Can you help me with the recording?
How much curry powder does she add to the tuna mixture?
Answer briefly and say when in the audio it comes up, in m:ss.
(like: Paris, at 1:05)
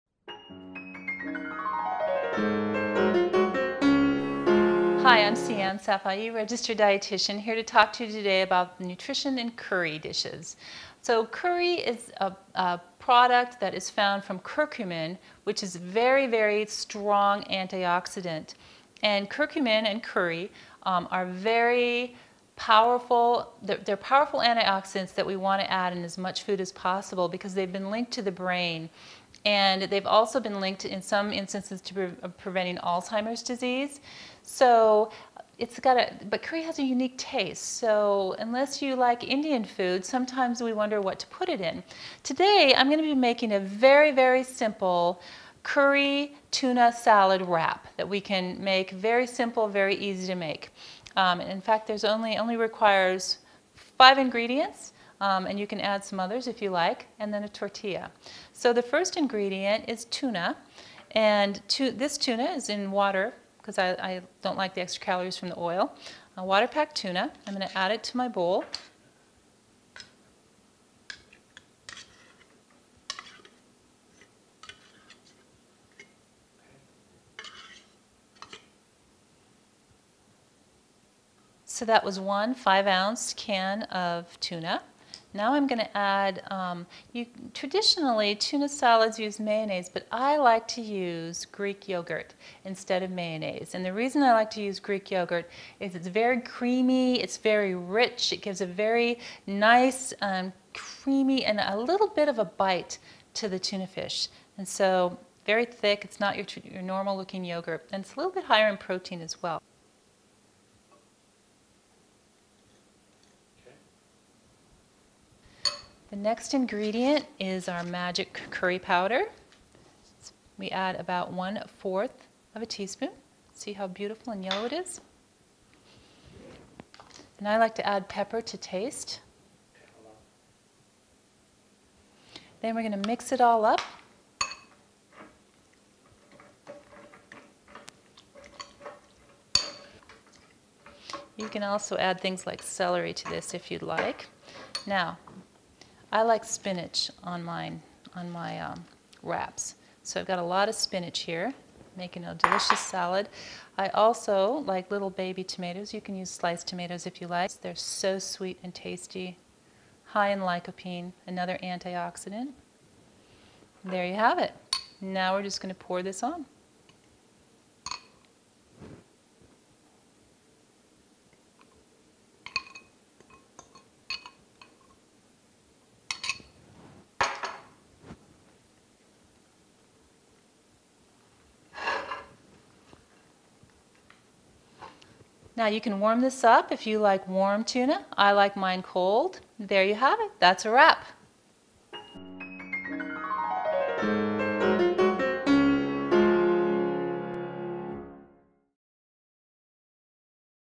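1/4 teaspoon, at 2:01.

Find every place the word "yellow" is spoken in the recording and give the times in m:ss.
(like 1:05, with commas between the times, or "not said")
2:04.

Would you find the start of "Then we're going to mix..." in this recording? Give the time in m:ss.
2:12.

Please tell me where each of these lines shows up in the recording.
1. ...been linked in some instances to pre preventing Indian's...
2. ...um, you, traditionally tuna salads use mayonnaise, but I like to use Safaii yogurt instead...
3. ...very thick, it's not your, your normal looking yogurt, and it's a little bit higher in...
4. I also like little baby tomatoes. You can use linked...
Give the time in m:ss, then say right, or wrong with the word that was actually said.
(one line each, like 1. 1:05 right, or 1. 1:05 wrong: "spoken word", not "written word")
1. 0:30 wrong: "Alzheimer", not "Indian"
2. 1:26 wrong: "Greek", not "Safaii"
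3. 1:45 right
4. 2:33 wrong: "sliced", not "linked".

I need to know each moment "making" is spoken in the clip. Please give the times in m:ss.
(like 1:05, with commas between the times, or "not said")
0:43, 2:31.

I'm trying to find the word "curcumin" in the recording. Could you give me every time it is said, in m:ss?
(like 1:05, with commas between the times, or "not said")
0:14, 0:19.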